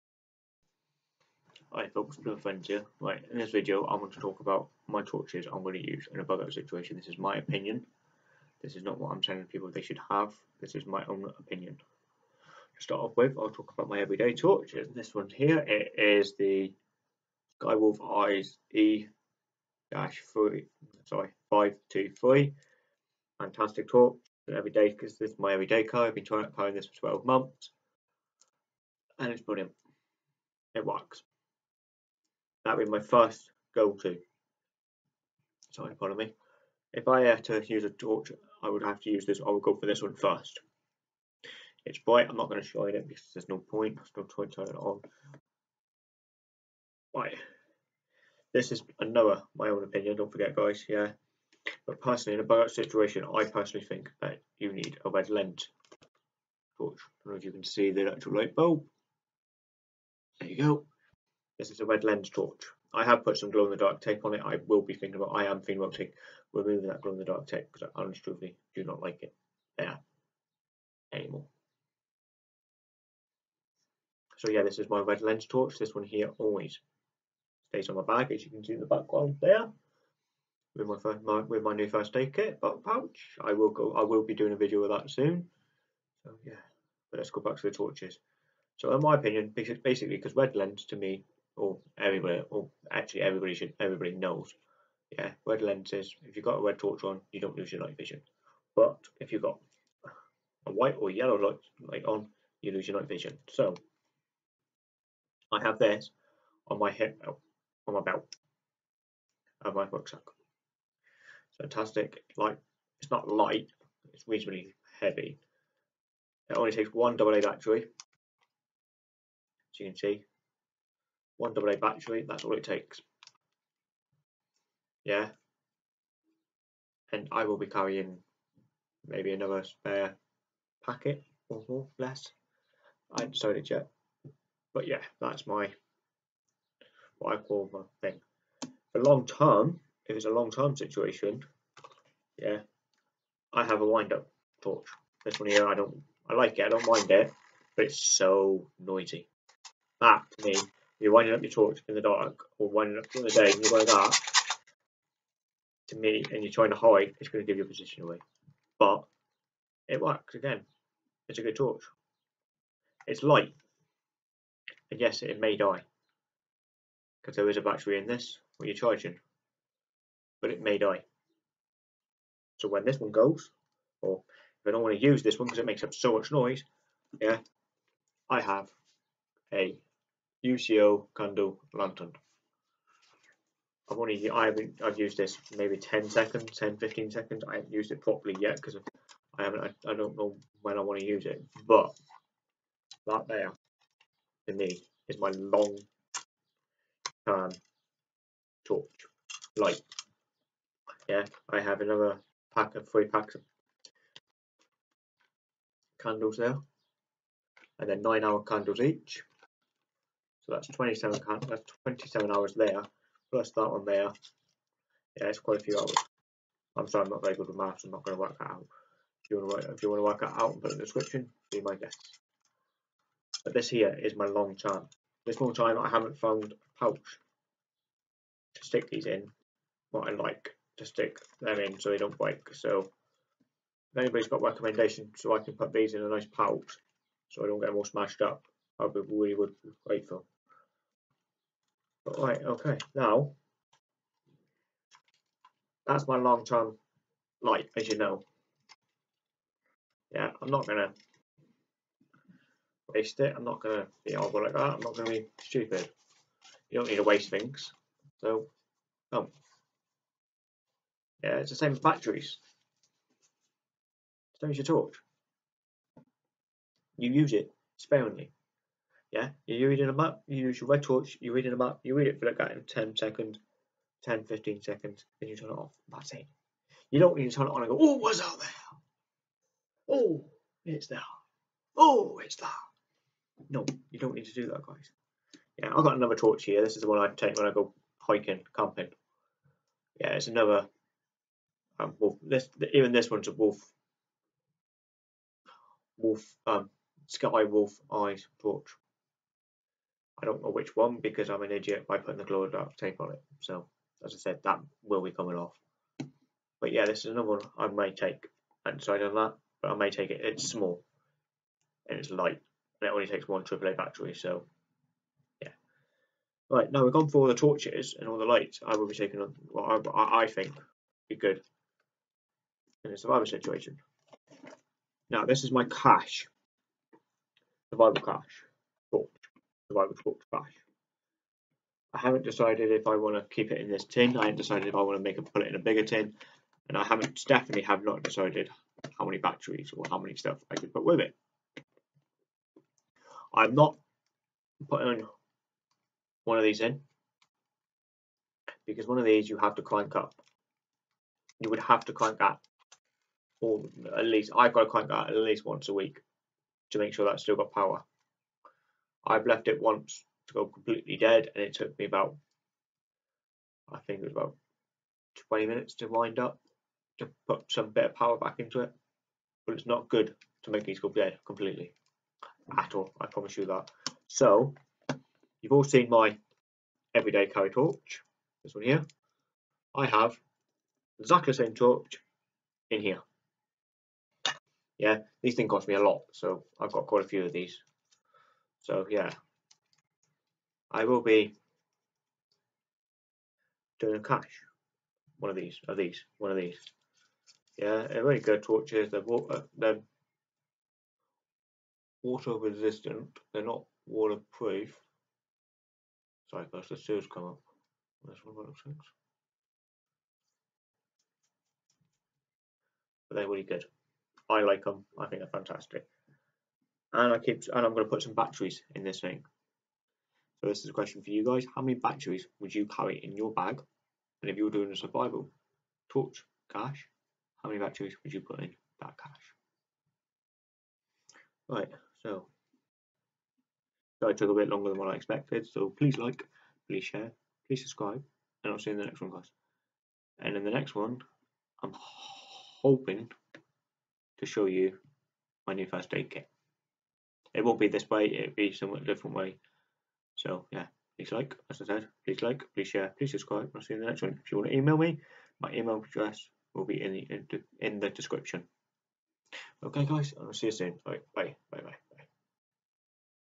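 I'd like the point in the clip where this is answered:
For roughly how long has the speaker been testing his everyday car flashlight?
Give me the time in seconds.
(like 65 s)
26 s.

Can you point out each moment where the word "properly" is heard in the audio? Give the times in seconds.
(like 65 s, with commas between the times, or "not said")
188 s.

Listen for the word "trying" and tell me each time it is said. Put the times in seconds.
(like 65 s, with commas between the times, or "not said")
26 s, 156 s.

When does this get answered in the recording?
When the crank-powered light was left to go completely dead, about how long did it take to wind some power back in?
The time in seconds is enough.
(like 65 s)
365 s.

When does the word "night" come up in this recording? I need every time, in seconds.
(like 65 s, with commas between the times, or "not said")
97 s, 102 s.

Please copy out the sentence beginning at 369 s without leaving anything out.
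But it's not good to make these go dead completely at all, I promise you that.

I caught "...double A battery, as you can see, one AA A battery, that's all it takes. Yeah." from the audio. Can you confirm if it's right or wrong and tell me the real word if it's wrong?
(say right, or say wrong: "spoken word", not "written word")
right.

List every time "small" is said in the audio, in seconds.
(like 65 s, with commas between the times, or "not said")
310 s.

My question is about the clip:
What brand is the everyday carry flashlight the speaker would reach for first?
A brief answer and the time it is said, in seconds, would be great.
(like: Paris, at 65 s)
Skywolf Eyes, at 17 s.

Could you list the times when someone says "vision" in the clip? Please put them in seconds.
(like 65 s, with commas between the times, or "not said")
97 s, 103 s.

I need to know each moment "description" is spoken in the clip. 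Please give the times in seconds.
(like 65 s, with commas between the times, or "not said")
220 s, 457 s.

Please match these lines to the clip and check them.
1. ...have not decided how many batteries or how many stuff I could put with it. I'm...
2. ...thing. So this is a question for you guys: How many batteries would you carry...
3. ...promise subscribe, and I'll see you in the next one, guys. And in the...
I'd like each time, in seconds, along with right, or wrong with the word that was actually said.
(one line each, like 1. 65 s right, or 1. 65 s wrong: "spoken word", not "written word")
1. 337 s right
2. 418 s right
3. 437 s wrong: "please", not "promise".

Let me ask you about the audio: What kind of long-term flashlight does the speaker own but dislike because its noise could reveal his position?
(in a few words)
wind up torch.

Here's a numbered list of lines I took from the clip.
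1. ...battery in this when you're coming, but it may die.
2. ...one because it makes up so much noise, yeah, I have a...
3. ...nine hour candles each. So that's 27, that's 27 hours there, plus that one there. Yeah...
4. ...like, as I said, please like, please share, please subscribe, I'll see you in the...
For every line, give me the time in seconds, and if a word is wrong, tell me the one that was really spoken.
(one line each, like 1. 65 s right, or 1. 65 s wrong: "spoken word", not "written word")
1. 167 s wrong: "charging", not "coming"
2. 175 s right
3. 208 s right
4. 451 s right.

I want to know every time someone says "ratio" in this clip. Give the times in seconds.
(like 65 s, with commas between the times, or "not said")
not said.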